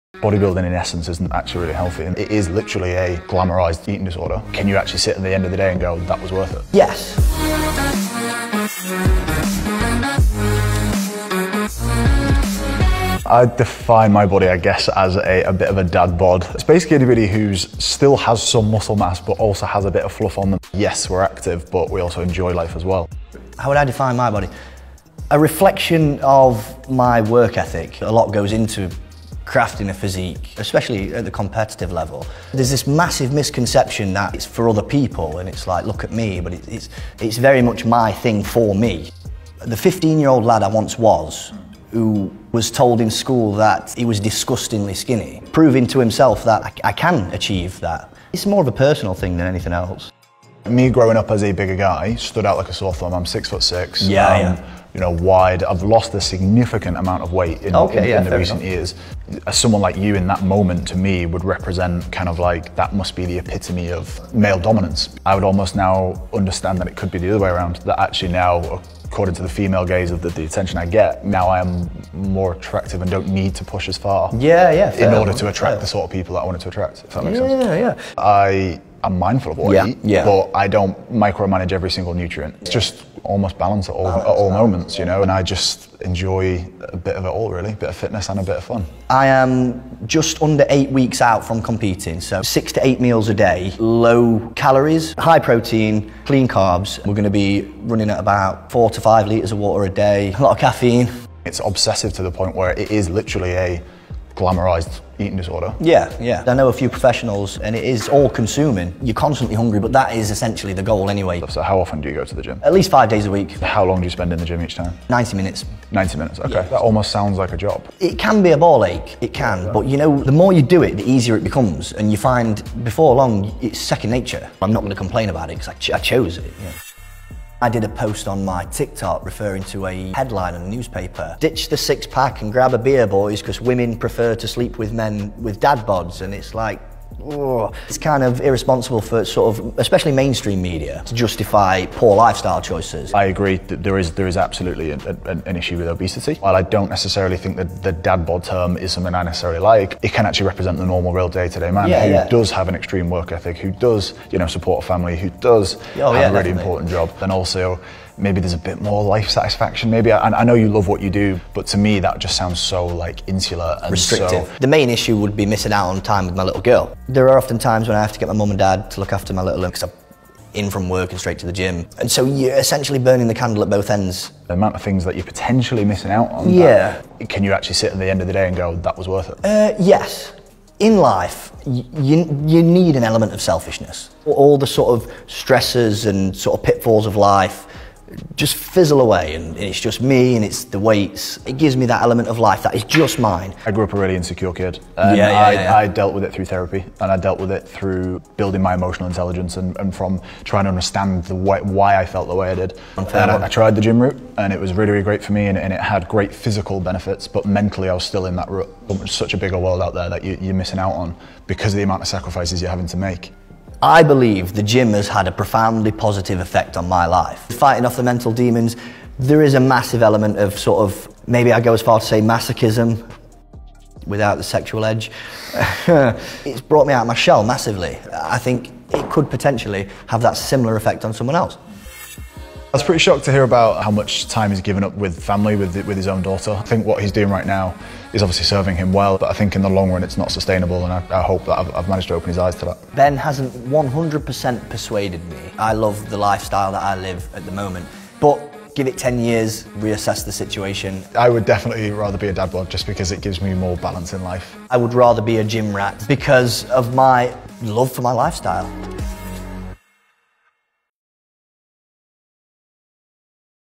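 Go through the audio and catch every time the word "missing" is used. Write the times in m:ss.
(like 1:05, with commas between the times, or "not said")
2:45, 2:55, 3:30.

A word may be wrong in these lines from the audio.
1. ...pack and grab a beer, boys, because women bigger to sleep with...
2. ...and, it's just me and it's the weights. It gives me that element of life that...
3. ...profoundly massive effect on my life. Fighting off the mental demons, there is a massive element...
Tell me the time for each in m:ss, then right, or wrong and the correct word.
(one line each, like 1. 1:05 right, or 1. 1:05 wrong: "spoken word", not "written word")
1. 2:12 wrong: "prefer", not "bigger"
2. 3:09 right
3. 3:35 wrong: "positive", not "massive".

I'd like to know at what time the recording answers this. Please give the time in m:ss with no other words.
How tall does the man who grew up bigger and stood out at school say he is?
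0:53.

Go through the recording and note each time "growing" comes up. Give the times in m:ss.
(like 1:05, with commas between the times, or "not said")
0:50.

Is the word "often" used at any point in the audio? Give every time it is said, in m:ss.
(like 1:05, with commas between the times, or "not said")
1:51, 2:47.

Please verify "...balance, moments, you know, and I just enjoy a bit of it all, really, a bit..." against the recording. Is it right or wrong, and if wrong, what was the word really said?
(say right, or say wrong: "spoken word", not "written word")
right.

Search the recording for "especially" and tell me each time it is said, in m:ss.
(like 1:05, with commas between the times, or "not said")
0:30, 2:19.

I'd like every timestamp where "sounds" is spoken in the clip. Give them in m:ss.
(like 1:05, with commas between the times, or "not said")
1:57, 2:42.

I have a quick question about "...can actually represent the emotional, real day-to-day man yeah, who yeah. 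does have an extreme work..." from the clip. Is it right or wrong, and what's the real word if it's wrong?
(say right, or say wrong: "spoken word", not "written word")
wrong: "normal", not "emotional".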